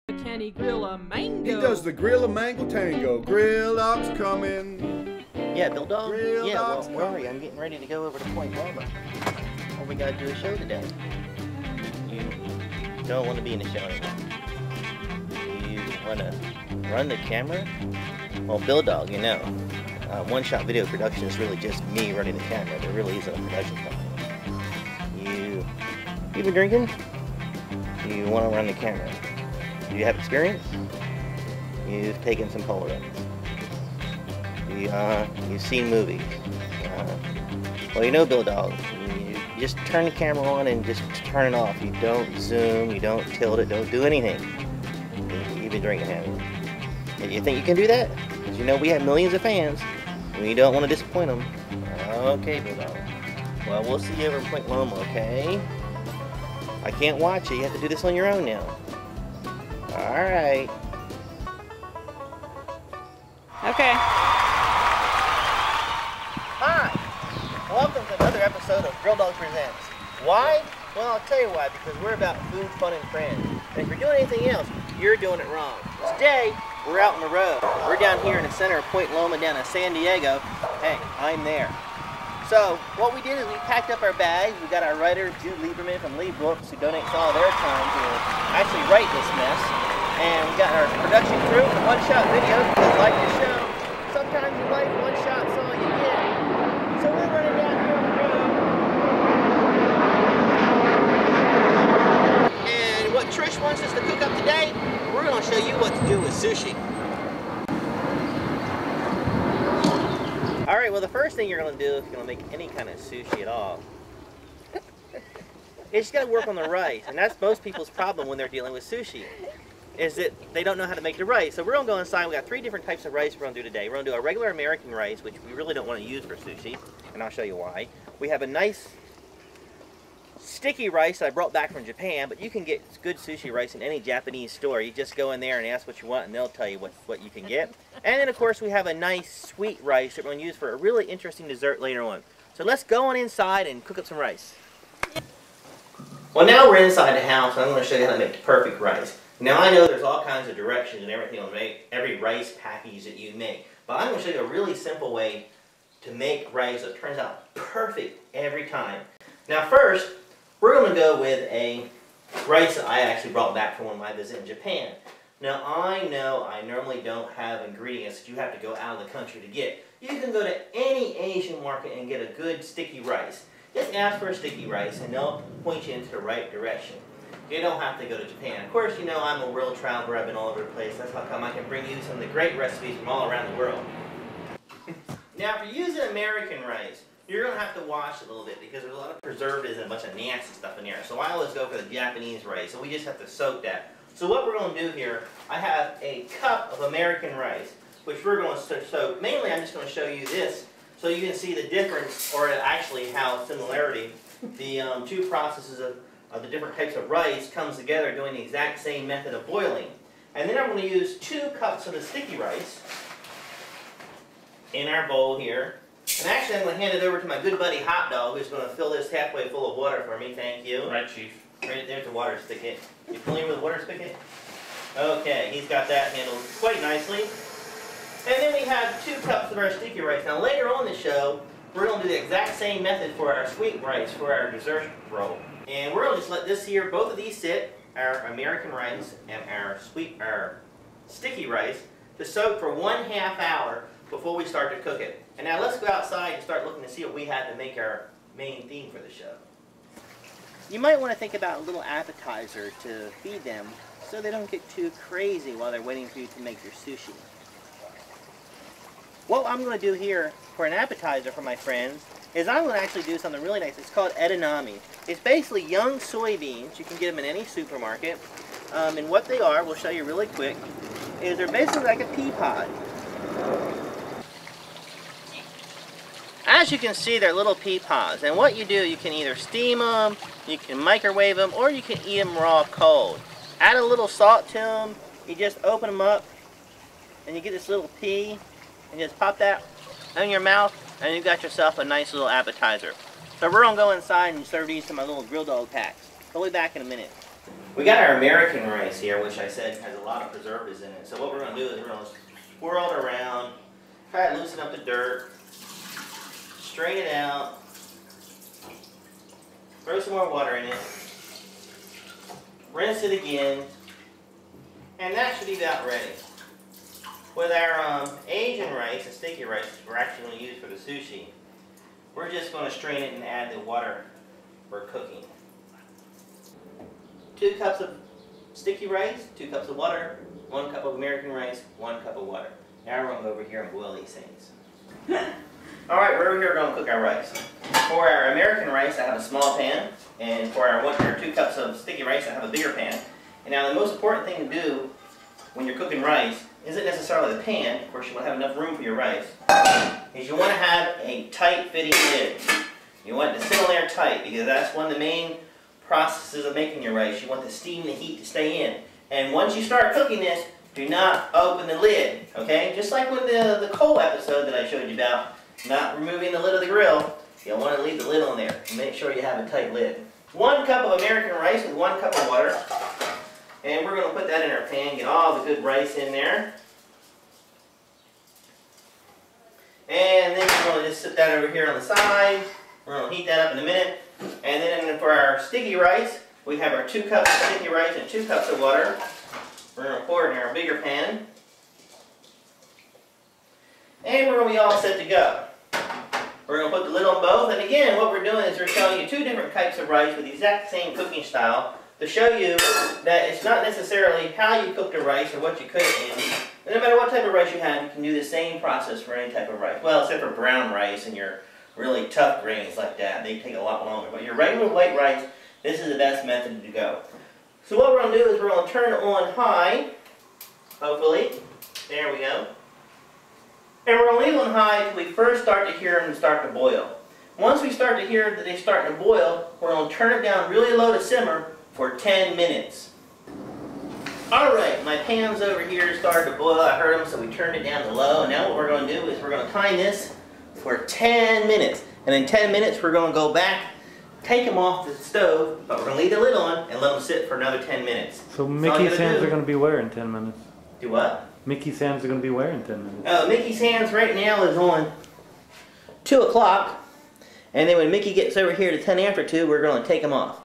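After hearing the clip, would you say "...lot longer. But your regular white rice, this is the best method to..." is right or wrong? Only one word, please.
right.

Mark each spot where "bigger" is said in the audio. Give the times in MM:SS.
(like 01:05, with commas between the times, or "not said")
05:42, 06:30.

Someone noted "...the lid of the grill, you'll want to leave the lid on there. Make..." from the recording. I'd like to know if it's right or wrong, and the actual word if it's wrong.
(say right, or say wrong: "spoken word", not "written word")
right.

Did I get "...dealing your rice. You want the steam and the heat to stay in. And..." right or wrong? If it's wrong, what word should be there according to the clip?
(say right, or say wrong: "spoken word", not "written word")
wrong: "making", not "dealing".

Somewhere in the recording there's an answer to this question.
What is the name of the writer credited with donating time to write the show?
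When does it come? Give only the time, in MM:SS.
01:25.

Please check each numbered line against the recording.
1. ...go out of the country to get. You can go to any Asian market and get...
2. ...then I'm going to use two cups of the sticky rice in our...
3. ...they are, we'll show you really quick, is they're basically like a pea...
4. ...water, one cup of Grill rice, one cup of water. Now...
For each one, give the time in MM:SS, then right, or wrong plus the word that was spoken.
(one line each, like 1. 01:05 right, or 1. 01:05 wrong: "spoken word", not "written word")
1. 02:48 right
2. 03:30 right
3. 04:29 right
4. 05:29 wrong: "American", not "Grill".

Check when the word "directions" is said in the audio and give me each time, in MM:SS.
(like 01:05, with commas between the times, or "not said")
02:30, 02:56.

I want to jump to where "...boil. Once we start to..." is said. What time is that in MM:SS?
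07:06.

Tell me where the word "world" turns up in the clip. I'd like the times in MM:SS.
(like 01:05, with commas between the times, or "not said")
02:59, 03:03.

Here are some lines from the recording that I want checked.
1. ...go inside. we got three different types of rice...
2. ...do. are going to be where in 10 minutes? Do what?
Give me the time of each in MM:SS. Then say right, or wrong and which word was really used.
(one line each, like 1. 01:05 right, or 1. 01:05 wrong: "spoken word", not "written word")
1. 02:01 right
2. 07:29 right.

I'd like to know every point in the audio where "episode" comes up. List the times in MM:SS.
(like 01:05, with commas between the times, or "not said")
01:08, 06:03.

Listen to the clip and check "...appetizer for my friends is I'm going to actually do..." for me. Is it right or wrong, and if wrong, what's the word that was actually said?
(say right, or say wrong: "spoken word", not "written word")
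right.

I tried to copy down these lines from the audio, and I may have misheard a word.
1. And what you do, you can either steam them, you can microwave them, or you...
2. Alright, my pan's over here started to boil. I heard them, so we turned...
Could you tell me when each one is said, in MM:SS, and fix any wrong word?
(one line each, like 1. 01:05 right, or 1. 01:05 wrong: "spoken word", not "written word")
1. 04:38 right
2. 07:14 right.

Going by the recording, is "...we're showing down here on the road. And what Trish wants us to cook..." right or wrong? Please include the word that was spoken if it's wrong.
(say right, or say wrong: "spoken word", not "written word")
wrong: "running", not "showing".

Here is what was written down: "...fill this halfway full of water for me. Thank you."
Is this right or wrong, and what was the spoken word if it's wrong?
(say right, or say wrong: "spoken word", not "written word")
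right.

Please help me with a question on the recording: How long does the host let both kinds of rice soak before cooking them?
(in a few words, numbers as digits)
one half hour.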